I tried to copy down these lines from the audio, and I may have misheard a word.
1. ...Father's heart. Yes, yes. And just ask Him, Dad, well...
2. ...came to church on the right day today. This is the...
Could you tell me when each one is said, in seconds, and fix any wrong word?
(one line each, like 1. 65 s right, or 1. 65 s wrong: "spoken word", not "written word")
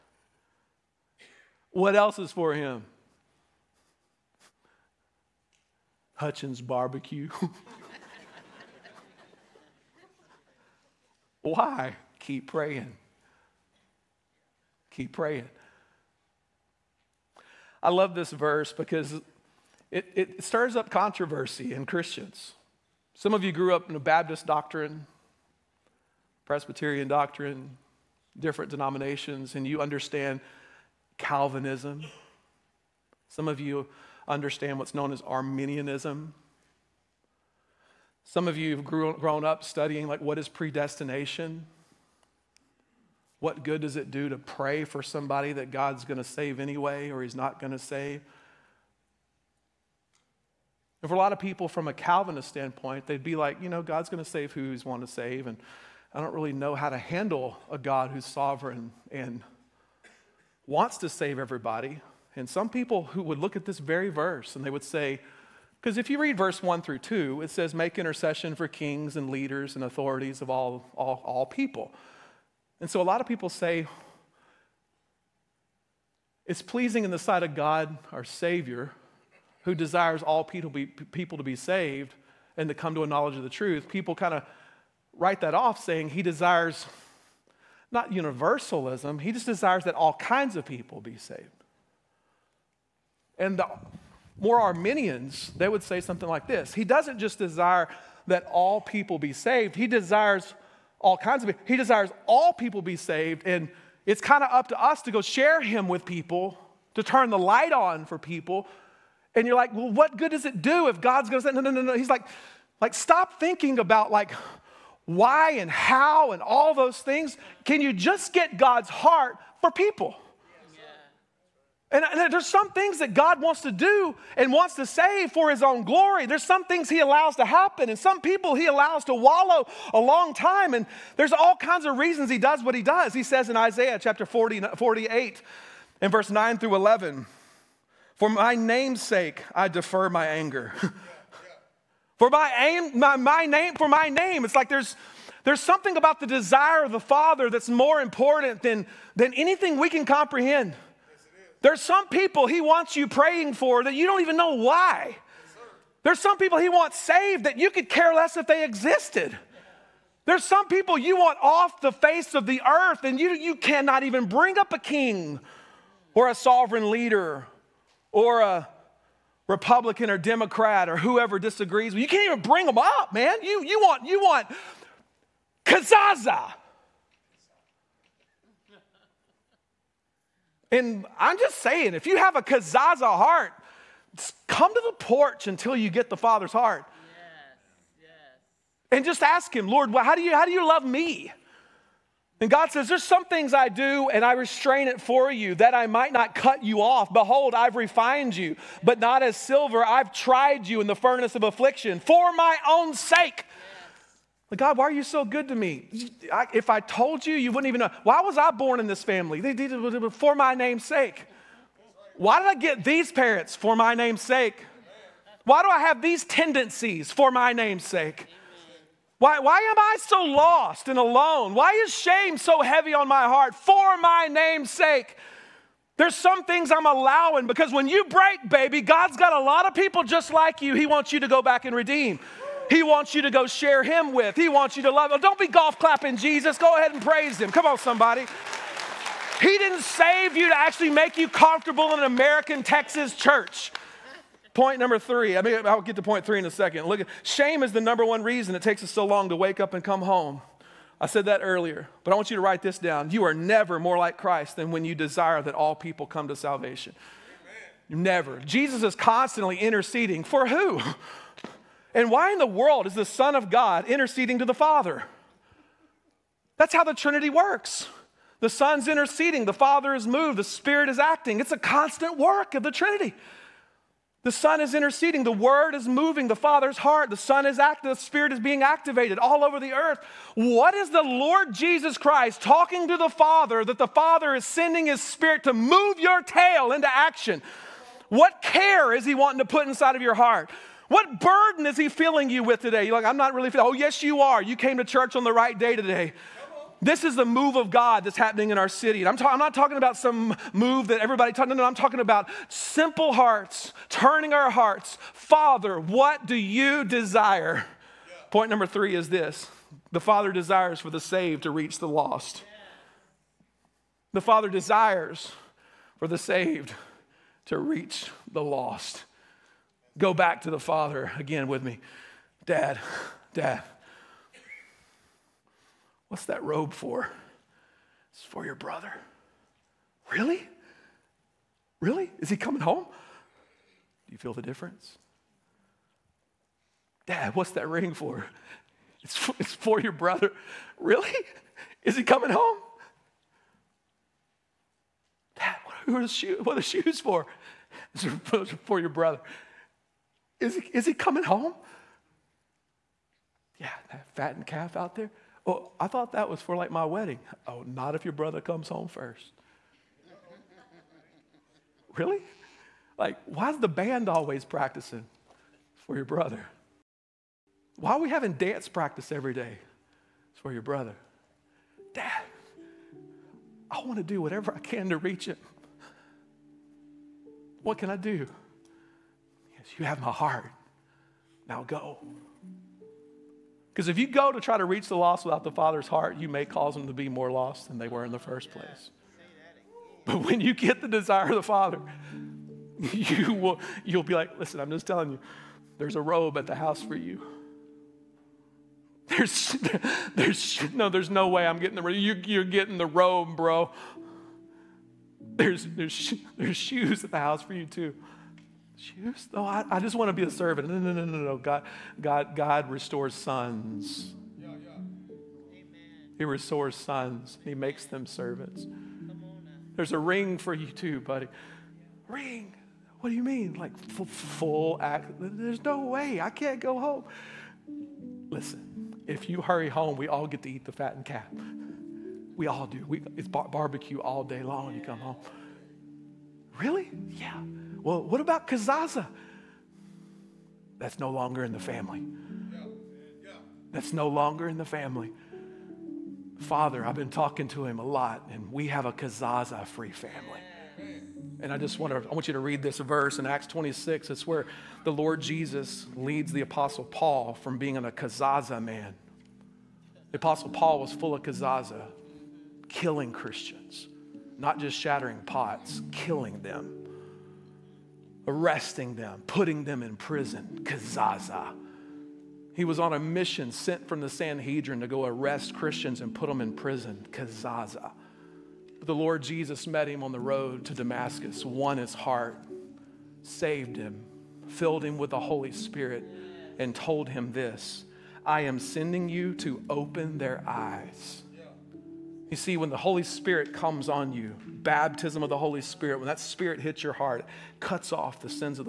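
1. 186 s wrong: "Lord", not "Dad"
2. 294 s right.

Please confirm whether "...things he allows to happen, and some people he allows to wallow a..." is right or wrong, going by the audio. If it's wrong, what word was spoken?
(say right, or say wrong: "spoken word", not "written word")
right.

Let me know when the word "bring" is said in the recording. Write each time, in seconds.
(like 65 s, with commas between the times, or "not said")
164 s, 172 s.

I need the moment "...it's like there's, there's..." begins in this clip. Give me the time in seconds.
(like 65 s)
144 s.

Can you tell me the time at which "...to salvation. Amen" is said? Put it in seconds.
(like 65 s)
256 s.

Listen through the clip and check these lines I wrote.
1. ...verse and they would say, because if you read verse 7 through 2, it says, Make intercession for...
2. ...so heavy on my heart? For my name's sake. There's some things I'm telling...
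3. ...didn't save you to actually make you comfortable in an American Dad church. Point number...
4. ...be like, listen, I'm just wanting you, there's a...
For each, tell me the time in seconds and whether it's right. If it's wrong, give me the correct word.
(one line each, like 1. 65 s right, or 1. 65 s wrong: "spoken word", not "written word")
1. 64 s wrong: "1", not "7"
2. 222 s wrong: "allowing", not "telling"
3. 239 s wrong: "Texas", not "Dad"
4. 394 s wrong: "telling", not "wanting".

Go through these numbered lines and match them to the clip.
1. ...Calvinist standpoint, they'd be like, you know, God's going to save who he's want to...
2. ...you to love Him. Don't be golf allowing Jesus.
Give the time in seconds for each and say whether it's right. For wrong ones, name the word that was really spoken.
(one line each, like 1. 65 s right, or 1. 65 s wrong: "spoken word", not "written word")
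1. 51 s right
2. 234 s wrong: "clapping", not "allowing".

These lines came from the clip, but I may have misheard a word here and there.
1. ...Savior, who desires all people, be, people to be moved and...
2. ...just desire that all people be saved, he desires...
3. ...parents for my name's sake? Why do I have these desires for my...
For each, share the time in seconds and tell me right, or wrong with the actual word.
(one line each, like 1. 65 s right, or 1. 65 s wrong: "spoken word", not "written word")
1. 78 s wrong: "saved", not "moved"
2. 97 s right
3. 213 s wrong: "tendencies", not "desires".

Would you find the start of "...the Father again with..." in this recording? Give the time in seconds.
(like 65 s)
320 s.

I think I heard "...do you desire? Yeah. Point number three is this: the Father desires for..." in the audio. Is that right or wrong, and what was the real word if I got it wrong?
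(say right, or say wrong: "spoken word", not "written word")
right.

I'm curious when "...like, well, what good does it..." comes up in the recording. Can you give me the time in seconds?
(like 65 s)
109 s.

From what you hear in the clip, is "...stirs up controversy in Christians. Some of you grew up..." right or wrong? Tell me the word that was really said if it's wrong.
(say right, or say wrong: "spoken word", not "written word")
right.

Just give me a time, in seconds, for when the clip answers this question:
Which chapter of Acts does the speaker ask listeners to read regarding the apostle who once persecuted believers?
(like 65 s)
453 s.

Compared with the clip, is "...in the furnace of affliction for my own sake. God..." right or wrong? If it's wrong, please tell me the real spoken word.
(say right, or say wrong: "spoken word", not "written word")
right.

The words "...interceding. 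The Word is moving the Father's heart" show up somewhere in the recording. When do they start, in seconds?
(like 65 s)
274 s.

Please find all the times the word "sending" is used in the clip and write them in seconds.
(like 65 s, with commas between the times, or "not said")
284 s, 488 s.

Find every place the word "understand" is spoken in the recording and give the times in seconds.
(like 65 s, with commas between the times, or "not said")
29 s, 34 s.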